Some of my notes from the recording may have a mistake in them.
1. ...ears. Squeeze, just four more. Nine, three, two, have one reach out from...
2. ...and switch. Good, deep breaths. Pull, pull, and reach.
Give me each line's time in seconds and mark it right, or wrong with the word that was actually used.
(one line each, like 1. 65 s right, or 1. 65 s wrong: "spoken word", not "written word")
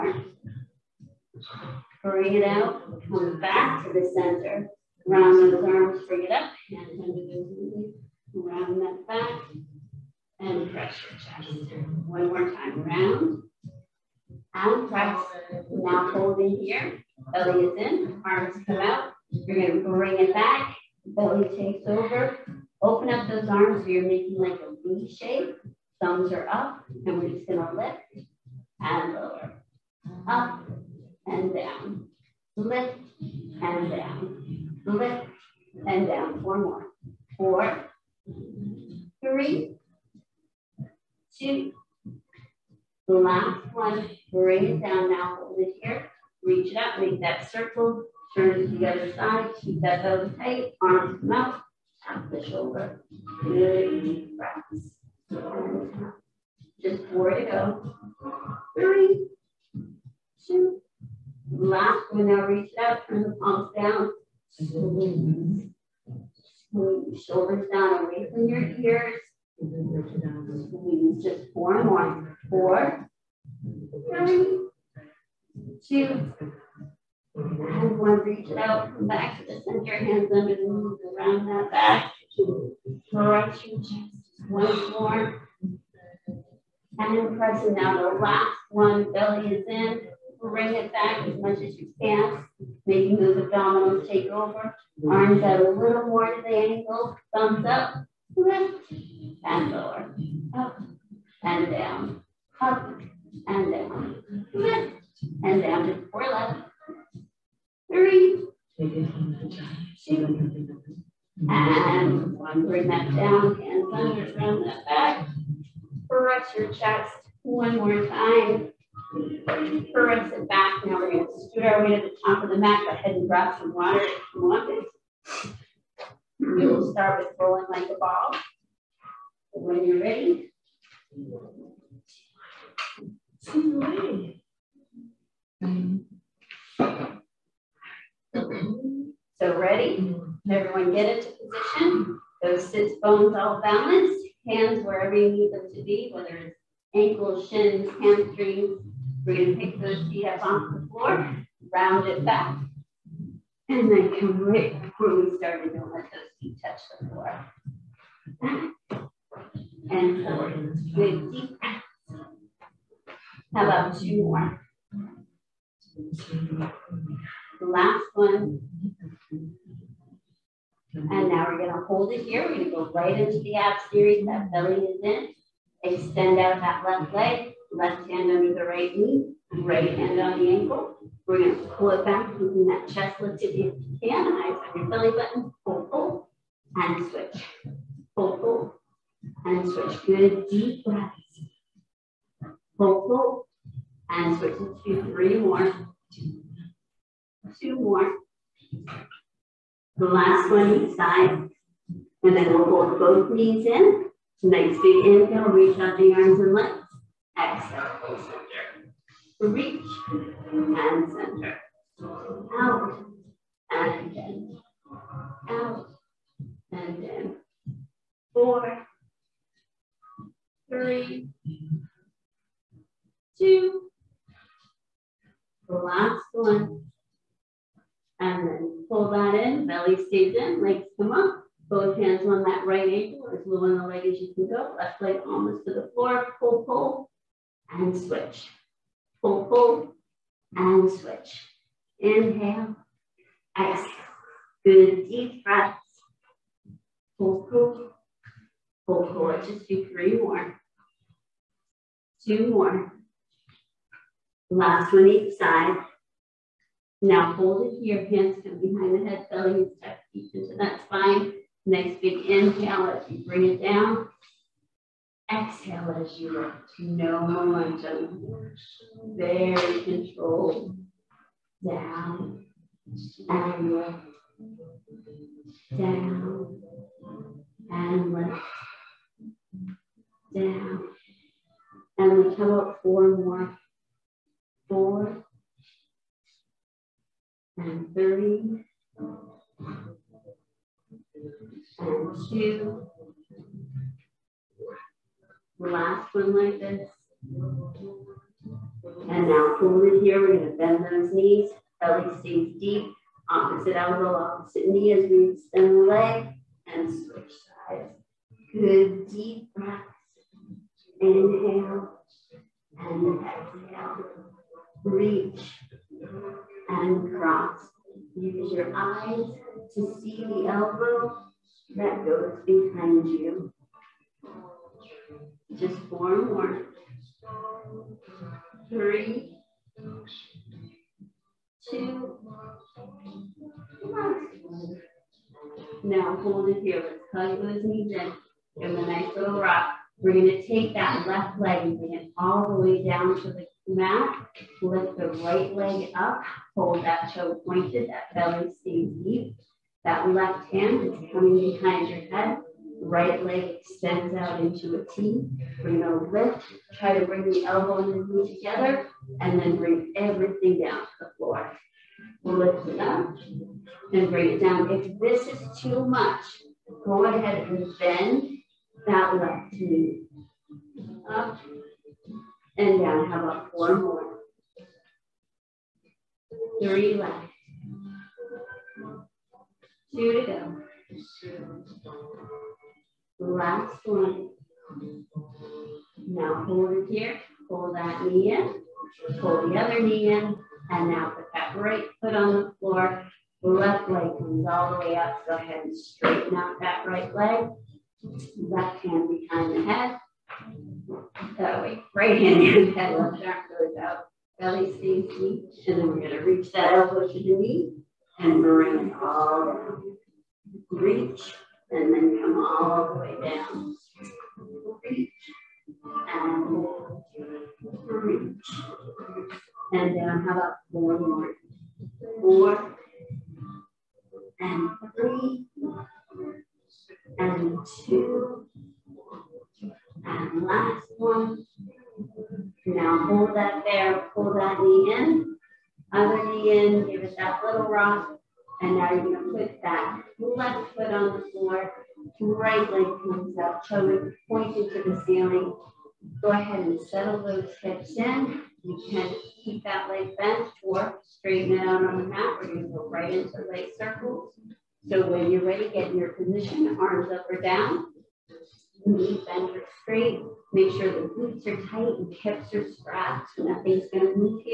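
1. 68 s wrong: "Four", not "Nine"
2. 189 s wrong: "switch", not "reach".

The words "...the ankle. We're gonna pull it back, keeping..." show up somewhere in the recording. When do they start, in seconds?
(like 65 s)
180 s.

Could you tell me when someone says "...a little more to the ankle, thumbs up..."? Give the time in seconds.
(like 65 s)
95 s.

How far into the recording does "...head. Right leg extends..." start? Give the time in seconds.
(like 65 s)
352 s.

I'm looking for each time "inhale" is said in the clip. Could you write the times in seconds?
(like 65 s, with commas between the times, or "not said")
205 s, 241 s, 262 s, 311 s.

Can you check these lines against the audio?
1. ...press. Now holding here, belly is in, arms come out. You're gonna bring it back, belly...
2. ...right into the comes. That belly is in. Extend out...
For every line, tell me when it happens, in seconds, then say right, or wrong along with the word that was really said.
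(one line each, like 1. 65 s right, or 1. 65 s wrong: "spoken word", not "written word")
1. 14 s right
2. 172 s wrong: "series", not "comes".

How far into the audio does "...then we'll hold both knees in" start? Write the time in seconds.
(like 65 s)
202 s.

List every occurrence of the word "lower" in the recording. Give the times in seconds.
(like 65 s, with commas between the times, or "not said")
29 s, 99 s.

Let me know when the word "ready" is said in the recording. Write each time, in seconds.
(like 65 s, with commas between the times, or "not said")
130 s, 139 s, 455 s.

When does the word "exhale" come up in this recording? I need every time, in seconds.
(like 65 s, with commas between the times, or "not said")
207 s, 243 s, 265 s, 313 s.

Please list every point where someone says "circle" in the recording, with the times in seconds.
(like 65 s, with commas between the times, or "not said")
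47 s, 453 s.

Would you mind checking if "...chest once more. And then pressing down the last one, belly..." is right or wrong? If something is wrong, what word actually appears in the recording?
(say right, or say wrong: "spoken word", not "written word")
right.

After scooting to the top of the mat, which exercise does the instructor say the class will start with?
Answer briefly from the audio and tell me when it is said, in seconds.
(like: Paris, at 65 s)
Rolling like a ball, at 127 s.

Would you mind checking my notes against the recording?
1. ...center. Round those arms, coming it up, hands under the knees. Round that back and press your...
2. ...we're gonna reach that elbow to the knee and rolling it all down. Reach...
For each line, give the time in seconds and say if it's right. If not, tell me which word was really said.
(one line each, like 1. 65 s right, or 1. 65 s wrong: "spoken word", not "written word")
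1. 4 s wrong: "bring", not "coming"
2. 405 s wrong: "bring", not "rolling".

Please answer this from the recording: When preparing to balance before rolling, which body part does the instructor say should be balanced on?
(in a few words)
Sits bones.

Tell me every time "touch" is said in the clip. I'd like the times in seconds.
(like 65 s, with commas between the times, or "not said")
156 s.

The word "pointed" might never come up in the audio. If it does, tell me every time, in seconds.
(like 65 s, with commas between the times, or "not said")
347 s, 444 s.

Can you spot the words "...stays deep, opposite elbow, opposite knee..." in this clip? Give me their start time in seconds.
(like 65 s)
302 s.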